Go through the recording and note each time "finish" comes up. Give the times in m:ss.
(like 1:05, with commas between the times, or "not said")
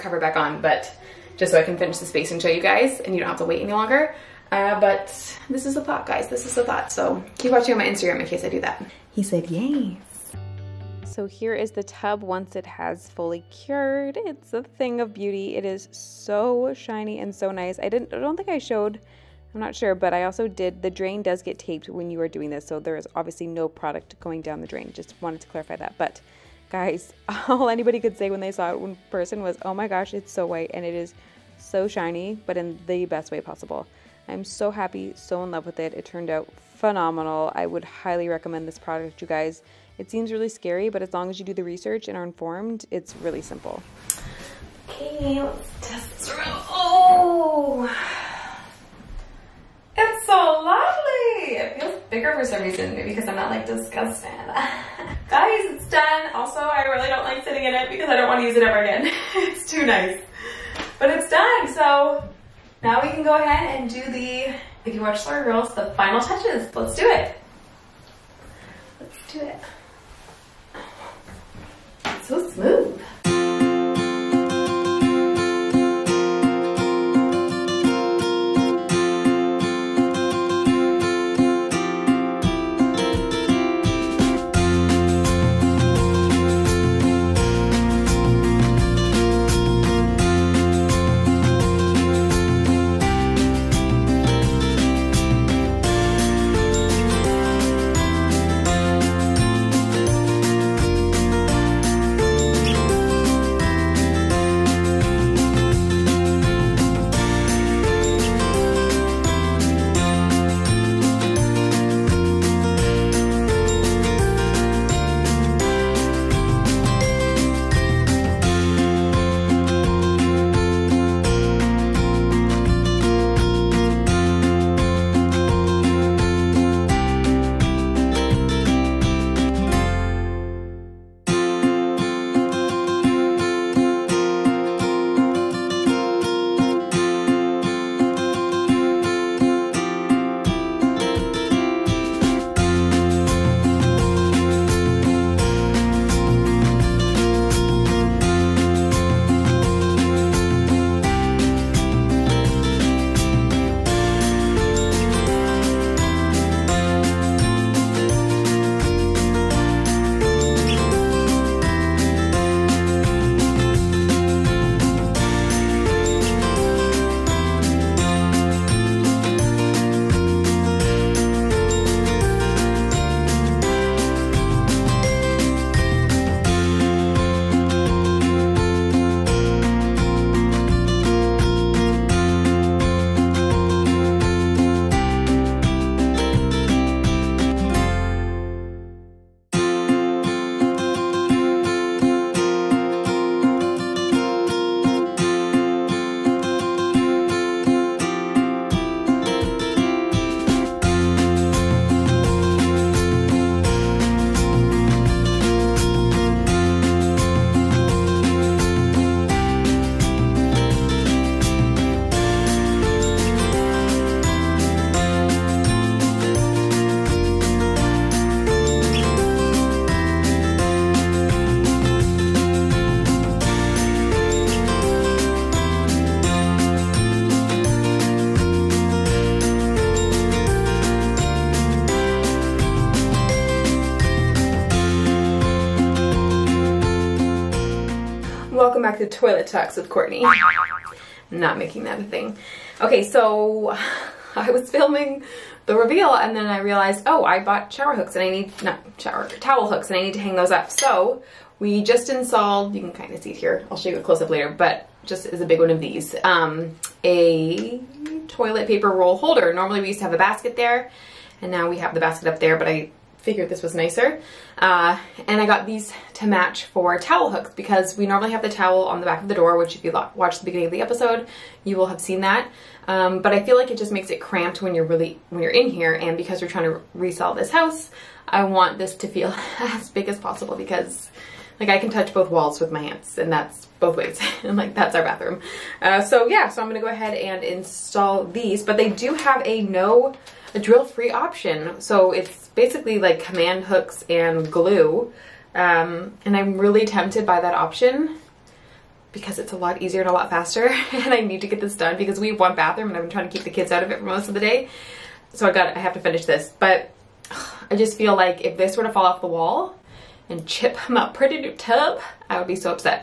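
0:01, 5:05.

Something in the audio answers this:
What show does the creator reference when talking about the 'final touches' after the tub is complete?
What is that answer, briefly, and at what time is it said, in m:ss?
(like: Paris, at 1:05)
Slurry Girls, at 1:05.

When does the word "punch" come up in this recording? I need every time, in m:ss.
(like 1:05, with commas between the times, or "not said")
not said.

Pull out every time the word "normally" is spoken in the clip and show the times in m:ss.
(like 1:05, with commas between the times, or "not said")
4:19, 4:28.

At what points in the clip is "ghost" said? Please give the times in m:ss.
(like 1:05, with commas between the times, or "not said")
not said.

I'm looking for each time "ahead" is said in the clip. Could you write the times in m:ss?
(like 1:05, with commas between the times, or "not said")
1:03, 4:46.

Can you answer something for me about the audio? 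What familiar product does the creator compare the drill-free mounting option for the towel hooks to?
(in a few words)
Command hooks.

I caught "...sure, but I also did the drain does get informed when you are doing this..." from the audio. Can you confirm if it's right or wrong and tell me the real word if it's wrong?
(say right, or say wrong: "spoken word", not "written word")
wrong: "taped", not "informed".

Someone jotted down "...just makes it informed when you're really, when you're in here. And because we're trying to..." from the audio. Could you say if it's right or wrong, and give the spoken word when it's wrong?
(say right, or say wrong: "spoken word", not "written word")
wrong: "cramped", not "informed".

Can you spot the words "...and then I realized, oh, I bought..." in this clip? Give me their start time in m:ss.
4:06.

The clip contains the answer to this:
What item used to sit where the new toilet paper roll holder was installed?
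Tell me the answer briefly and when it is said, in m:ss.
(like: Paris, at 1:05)
A basket, at 4:20.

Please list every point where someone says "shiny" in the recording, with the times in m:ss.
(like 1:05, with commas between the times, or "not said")
0:16, 0:31.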